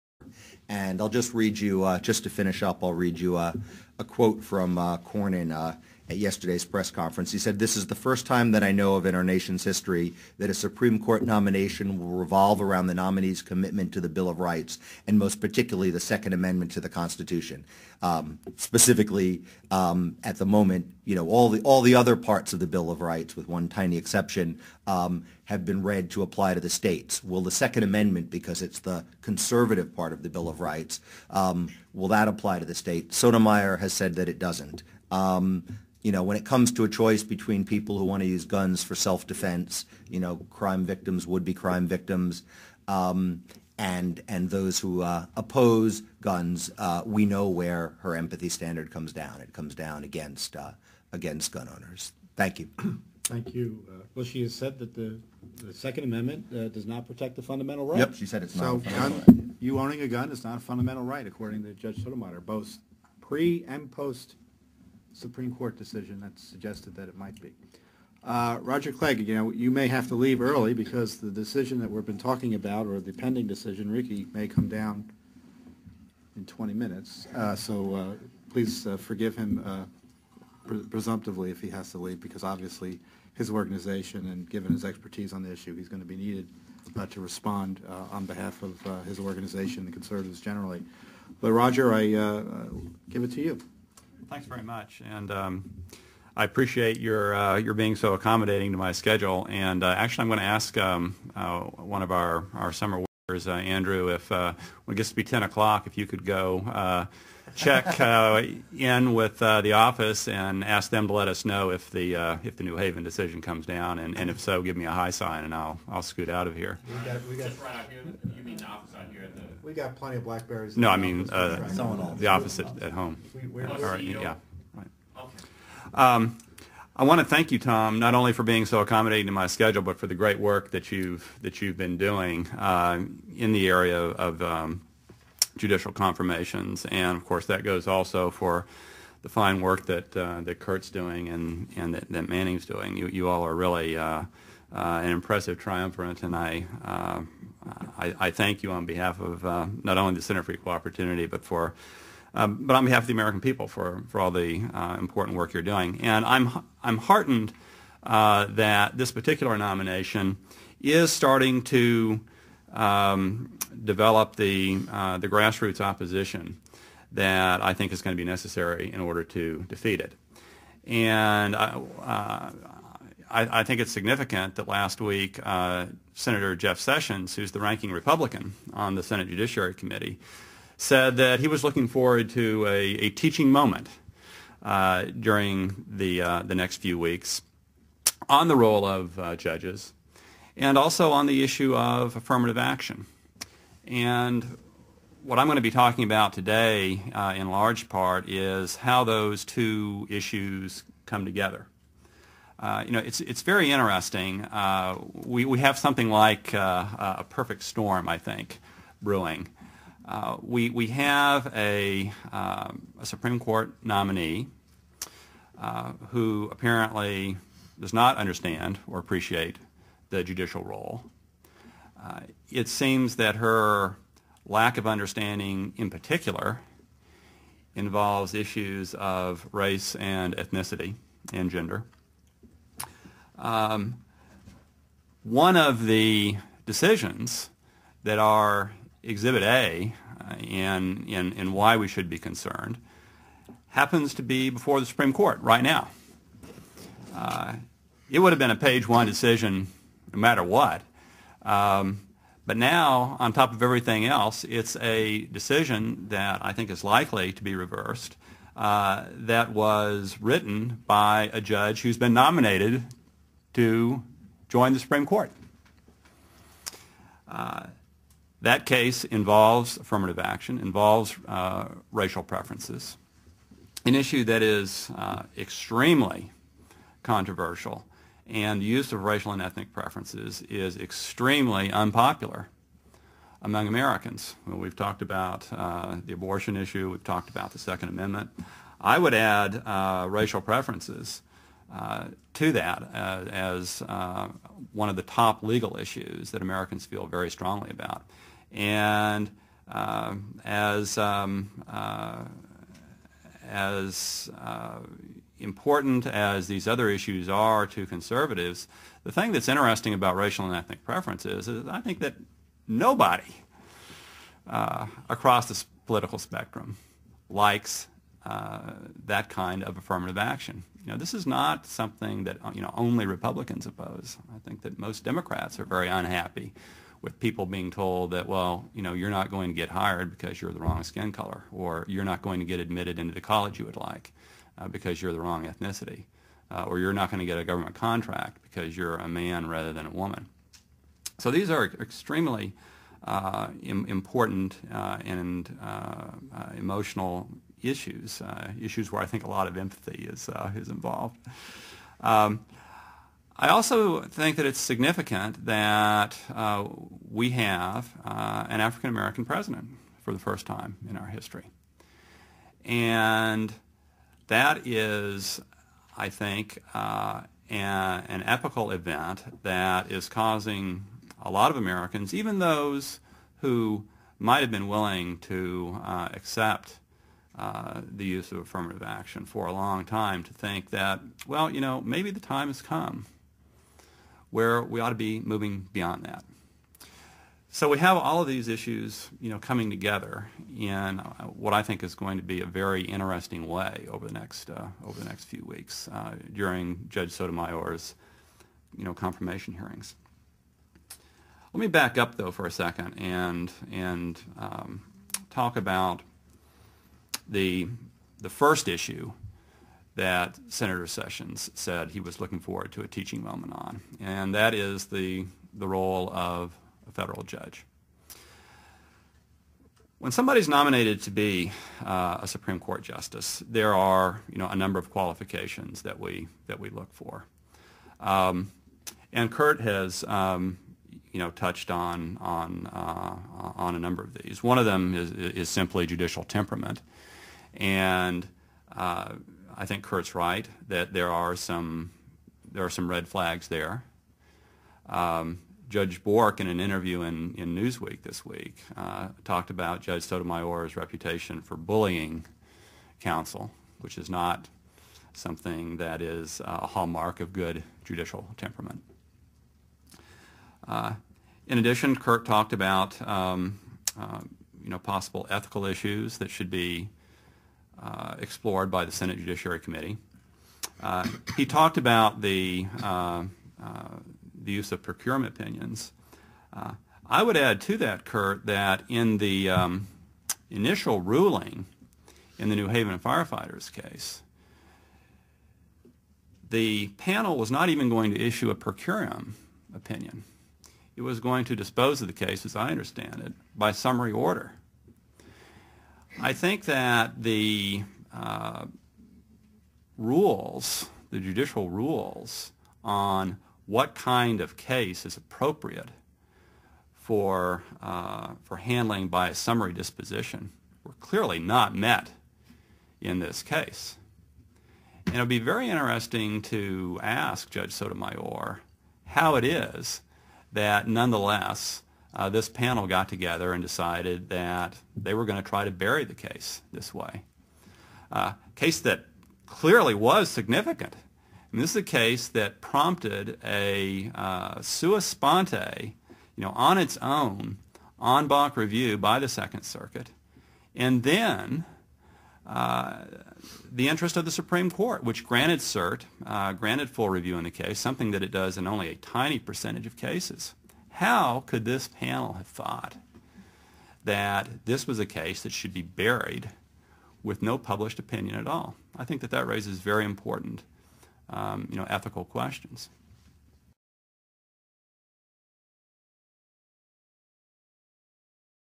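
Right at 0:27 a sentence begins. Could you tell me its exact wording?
Will the Second Amendment, because it's the conservative part of the Bill of Rights, um, will that apply to the state?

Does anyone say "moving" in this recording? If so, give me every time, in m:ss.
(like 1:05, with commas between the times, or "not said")
6:25.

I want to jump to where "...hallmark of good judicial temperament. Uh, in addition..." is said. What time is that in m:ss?
7:36.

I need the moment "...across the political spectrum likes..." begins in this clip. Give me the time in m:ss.
5:14.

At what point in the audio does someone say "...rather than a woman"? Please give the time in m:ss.
5:39.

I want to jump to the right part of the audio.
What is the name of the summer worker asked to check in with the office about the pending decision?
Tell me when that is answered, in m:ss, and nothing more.
1:43.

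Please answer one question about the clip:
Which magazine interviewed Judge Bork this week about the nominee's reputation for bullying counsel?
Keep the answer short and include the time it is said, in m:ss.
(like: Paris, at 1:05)
Newsweek, at 7:27.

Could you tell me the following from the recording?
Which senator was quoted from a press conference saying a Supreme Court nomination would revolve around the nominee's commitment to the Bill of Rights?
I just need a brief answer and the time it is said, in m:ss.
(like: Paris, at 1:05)
Cornyn, at 0:04.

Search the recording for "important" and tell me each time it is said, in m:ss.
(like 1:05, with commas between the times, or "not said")
2:34, 5:05, 5:43, 9:20.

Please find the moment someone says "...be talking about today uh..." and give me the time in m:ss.
3:15.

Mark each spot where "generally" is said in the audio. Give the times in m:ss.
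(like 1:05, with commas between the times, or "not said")
1:30.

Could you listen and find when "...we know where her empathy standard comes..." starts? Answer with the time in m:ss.
0:47.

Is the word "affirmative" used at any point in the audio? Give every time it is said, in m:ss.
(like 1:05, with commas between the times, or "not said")
3:12, 4:29, 5:19, 6:18.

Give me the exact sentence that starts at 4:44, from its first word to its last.
Well, we've talked about uh, the abortion issue, we've talked about the Second Amendment.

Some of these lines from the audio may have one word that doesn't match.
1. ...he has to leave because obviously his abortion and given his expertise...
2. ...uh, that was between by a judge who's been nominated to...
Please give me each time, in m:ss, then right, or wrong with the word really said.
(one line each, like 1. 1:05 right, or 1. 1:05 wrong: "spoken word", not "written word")
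1. 1:21 wrong: "organization", not "abortion"
2. 4:18 wrong: "written", not "between".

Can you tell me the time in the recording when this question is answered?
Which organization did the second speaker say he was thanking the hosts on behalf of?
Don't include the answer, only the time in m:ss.
2:30.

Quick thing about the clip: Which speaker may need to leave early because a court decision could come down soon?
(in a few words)
Roger Clegg.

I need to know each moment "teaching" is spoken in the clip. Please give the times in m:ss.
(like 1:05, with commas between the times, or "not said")
3:03, 6:52.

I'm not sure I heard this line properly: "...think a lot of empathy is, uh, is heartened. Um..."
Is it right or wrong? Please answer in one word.
wrong.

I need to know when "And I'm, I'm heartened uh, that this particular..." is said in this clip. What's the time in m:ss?
2:36.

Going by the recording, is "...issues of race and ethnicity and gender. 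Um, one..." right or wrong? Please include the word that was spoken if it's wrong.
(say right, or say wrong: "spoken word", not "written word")
right.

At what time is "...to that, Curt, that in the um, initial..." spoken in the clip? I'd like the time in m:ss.
7:57.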